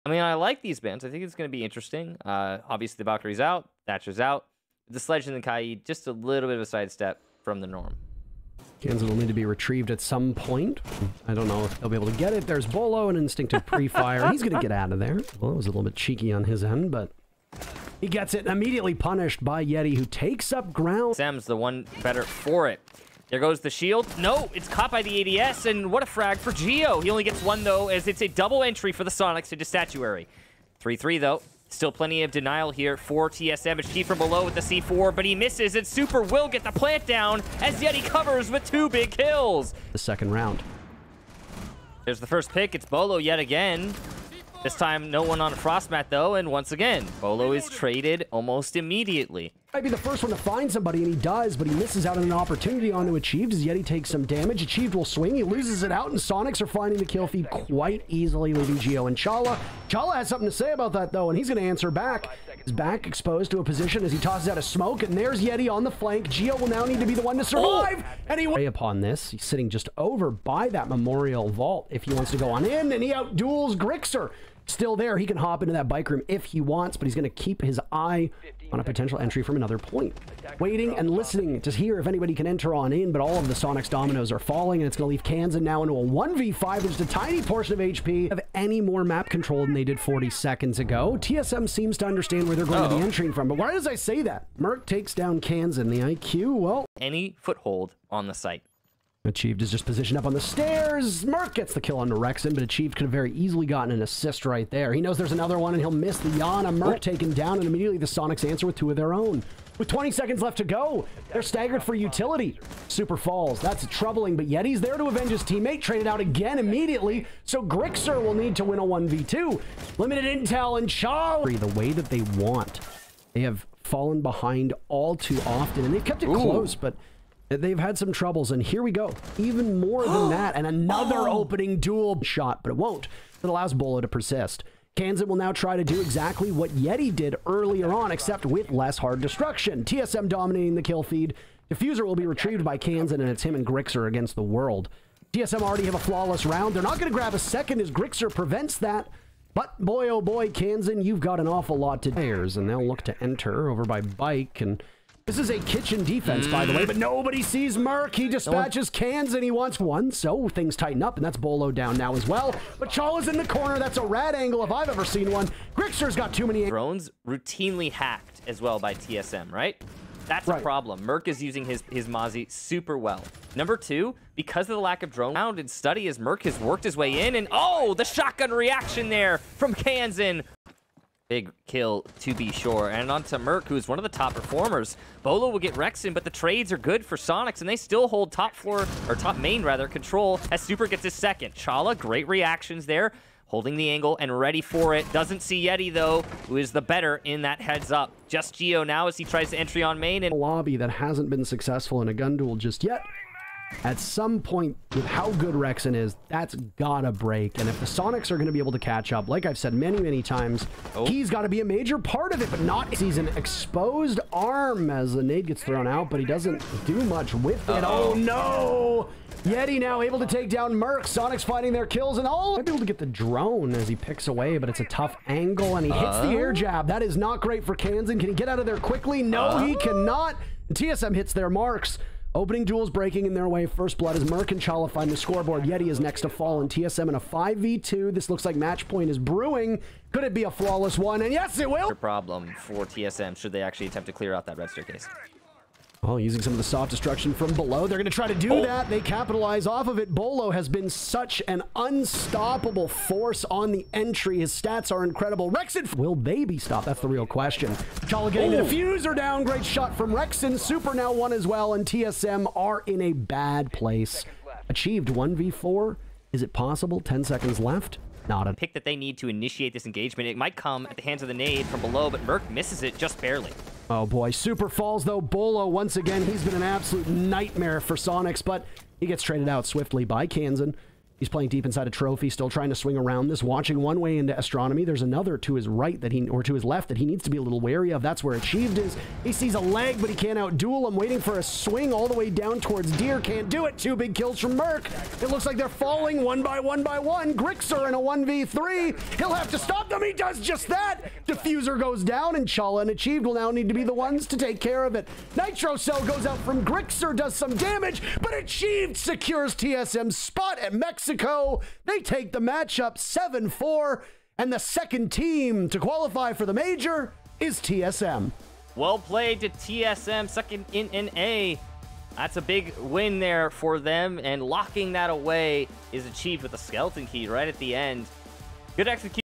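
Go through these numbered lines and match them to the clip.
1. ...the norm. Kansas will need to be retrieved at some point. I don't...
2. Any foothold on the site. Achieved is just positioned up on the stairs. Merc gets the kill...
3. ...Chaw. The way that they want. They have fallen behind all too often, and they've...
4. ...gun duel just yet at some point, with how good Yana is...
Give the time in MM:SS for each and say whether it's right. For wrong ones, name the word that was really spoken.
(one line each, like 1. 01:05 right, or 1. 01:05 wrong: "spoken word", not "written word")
1. 00:07 right
2. 01:36 right
3. 02:00 right
4. 03:22 wrong: "Rexen", not "Yana".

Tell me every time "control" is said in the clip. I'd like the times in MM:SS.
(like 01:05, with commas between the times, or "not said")
01:29, 03:09.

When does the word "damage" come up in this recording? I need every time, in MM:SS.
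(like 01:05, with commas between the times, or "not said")
00:54, 05:07.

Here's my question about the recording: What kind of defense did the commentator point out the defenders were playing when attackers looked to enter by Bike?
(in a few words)
A kitchen defense.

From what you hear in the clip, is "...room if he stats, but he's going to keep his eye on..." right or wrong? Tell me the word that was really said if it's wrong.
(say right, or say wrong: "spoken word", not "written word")
wrong: "wants", not "stats".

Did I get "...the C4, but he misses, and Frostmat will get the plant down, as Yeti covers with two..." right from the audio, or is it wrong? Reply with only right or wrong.
wrong.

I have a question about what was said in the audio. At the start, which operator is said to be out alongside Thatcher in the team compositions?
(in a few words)
Valkyrie.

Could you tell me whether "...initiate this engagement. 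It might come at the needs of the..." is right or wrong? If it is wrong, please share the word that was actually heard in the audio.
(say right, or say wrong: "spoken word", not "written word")
wrong: "hands", not "needs".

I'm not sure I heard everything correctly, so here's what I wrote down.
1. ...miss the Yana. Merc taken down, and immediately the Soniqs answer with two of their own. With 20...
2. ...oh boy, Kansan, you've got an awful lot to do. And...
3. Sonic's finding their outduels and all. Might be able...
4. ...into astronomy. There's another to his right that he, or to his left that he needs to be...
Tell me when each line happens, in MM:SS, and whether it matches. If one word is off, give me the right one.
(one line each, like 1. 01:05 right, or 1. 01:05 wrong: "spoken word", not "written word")
1. 01:45 right
2. 02:30 right
3. 03:41 wrong: "kills", not "outduels"
4. 04:44 right.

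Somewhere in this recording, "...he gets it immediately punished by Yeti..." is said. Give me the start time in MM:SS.
00:18.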